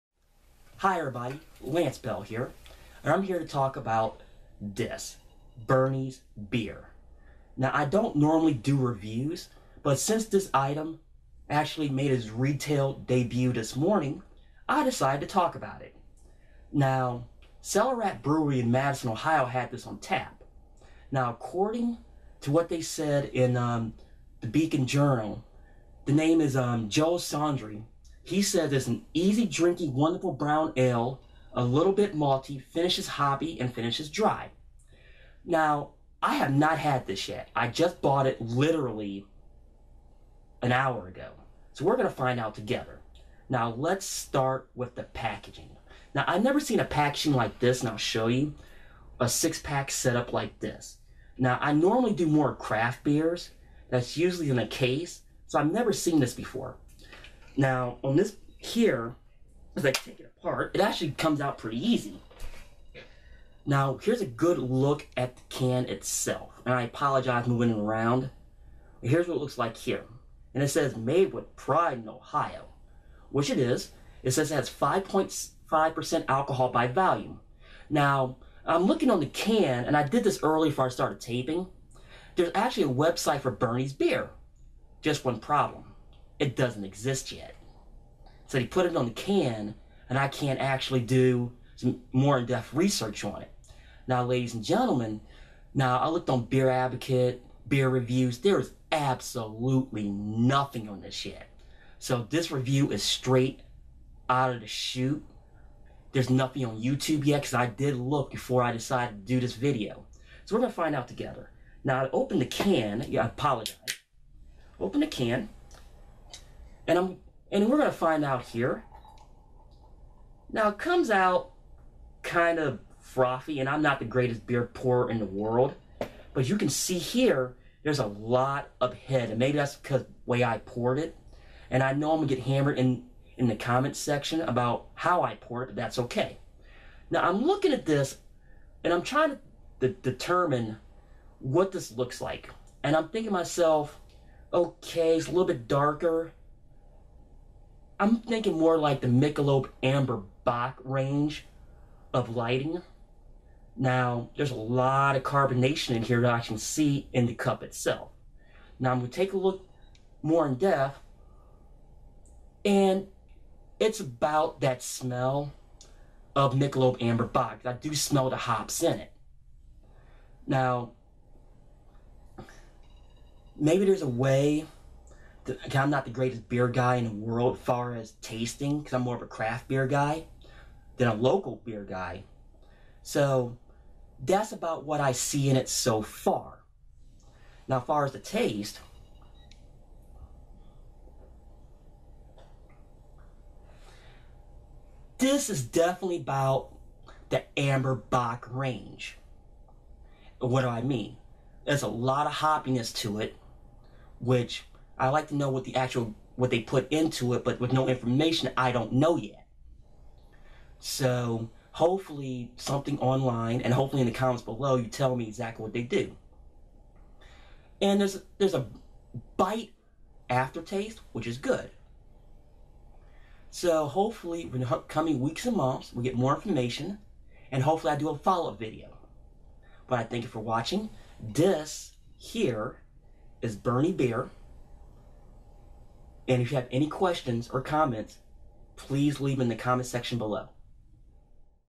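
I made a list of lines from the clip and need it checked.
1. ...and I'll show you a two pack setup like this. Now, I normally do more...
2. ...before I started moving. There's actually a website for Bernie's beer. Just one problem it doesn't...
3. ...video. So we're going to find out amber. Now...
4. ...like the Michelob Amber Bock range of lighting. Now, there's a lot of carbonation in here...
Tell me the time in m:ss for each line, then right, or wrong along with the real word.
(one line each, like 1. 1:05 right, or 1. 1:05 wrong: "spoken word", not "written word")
1. 0:47 wrong: "six", not "two"
2. 1:20 wrong: "taping", not "moving"
3. 1:49 wrong: "together", not "amber"
4. 2:28 right.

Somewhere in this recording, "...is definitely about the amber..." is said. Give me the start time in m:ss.
3:15.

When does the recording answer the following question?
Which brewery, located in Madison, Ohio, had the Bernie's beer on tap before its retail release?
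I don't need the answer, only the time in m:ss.
0:17.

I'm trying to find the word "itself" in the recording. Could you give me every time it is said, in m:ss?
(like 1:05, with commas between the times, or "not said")
1:05, 2:37.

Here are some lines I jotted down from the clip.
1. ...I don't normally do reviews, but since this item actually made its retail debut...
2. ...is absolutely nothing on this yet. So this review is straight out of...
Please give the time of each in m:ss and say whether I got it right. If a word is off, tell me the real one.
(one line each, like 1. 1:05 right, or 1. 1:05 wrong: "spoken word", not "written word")
1. 0:07 right
2. 1:38 right.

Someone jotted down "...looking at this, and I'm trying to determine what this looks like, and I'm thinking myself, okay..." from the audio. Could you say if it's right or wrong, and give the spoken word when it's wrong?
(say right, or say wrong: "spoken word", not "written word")
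right.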